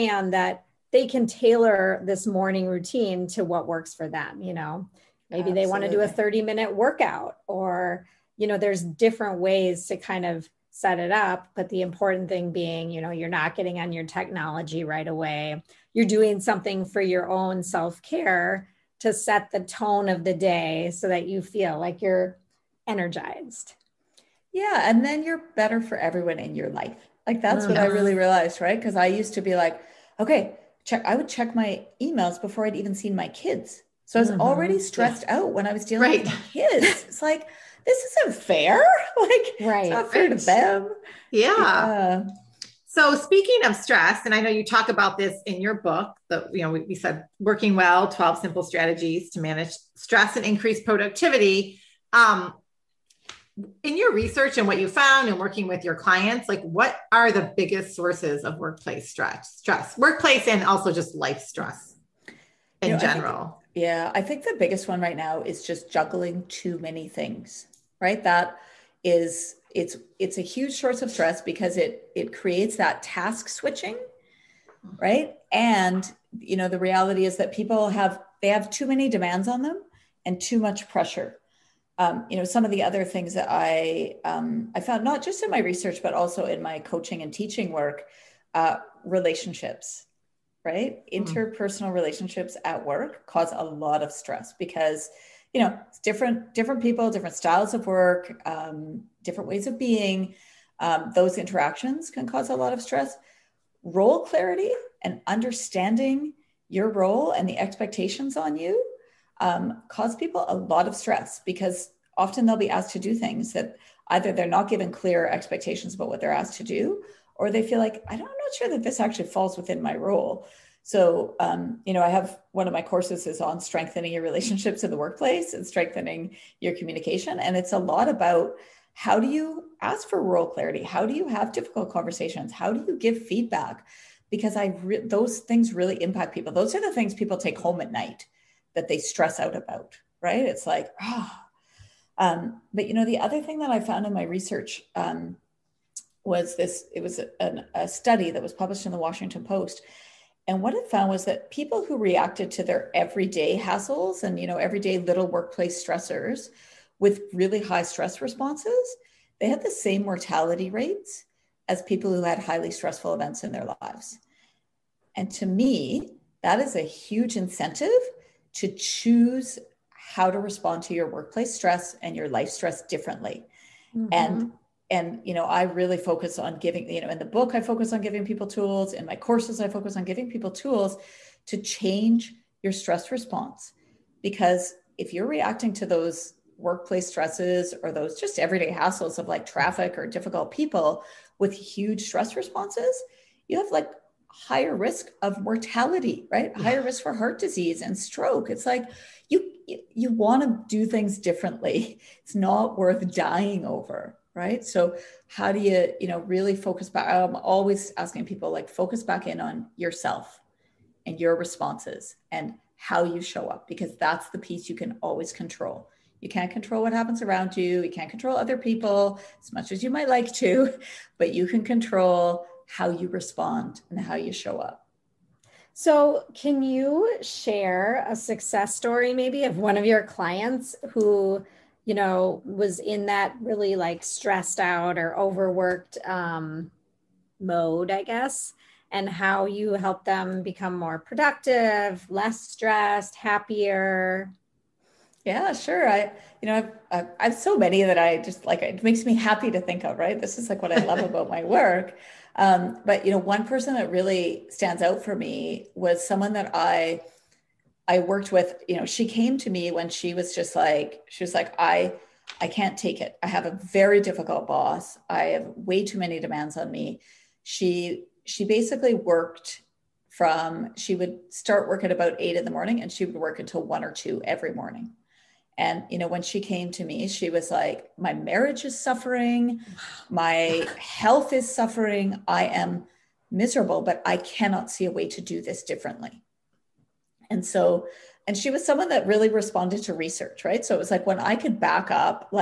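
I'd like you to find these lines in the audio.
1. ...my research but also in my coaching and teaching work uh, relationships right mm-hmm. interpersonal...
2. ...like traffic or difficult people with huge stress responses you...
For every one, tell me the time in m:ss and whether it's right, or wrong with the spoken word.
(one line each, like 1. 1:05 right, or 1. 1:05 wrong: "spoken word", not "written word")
1. 1:25 right
2. 3:09 right.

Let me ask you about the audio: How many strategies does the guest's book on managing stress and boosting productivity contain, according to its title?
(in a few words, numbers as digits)
12.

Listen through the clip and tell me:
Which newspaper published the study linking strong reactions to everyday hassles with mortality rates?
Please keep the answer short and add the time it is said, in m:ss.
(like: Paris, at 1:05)
Washington Post, at 2:28.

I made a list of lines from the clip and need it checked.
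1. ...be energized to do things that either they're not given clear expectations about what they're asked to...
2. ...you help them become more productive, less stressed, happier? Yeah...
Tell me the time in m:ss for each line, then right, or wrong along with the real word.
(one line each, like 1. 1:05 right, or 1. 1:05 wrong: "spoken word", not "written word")
1. 1:52 wrong: "asked", not "energized"
2. 3:59 right.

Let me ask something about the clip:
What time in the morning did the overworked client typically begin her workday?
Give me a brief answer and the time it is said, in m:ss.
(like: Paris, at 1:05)
8, at 4:32.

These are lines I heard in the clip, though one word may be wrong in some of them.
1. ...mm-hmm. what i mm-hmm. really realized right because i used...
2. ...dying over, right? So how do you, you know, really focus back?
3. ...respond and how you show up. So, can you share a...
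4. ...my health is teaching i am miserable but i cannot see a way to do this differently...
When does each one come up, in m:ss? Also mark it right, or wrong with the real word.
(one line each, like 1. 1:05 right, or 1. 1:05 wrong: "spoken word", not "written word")
1. 0:27 right
2. 3:23 right
3. 3:43 right
4. 4:40 wrong: "suffering", not "teaching".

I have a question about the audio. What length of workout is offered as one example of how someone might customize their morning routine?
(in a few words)
30 minutes.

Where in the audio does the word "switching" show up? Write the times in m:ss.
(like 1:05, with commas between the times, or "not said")
1:13.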